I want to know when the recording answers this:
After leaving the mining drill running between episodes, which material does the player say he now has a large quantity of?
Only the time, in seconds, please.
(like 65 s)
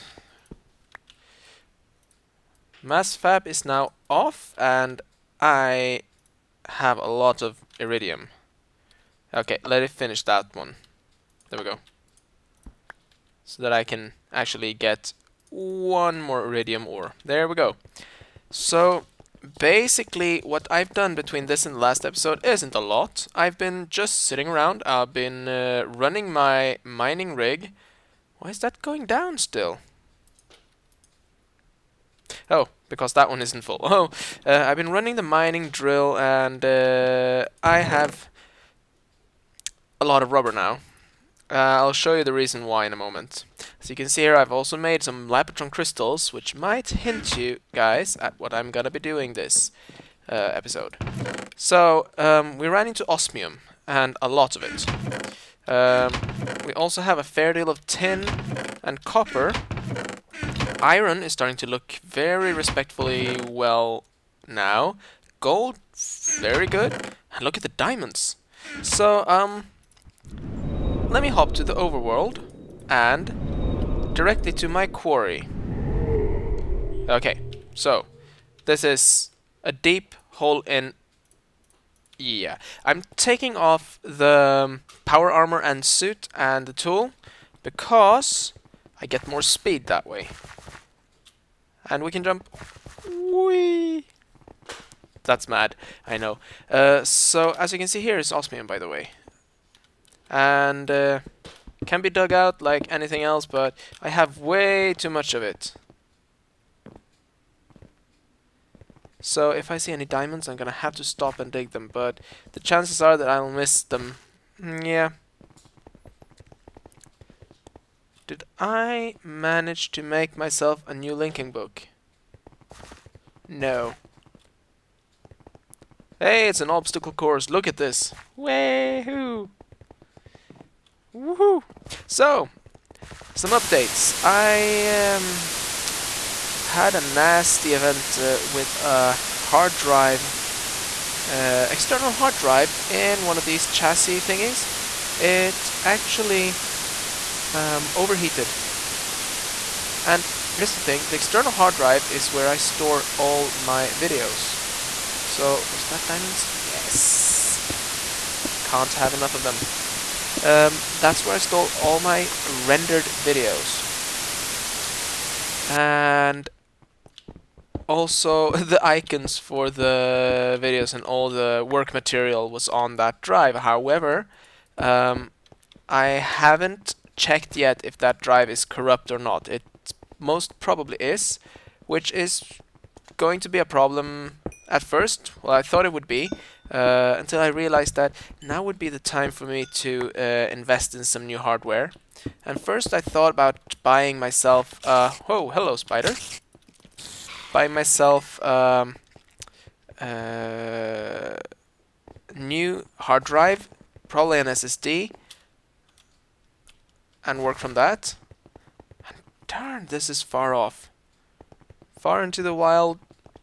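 40 s.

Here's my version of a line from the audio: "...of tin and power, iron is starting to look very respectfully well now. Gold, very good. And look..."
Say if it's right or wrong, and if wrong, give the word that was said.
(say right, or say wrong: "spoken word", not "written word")
wrong: "copper", not "power".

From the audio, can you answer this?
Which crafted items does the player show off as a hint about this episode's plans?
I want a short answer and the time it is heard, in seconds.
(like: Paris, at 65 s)
Lapotron crystals, at 45 s.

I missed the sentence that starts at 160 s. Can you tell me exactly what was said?
Um, that's where I store all my rendered videos.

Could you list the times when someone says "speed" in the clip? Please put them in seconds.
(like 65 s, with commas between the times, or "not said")
89 s.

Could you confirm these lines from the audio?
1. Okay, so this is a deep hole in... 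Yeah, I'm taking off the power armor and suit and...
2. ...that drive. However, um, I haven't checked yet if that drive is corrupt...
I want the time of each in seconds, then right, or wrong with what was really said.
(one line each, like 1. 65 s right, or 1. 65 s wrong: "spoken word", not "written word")
1. 77 s right
2. 172 s right.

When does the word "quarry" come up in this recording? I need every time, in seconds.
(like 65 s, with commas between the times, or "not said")
74 s.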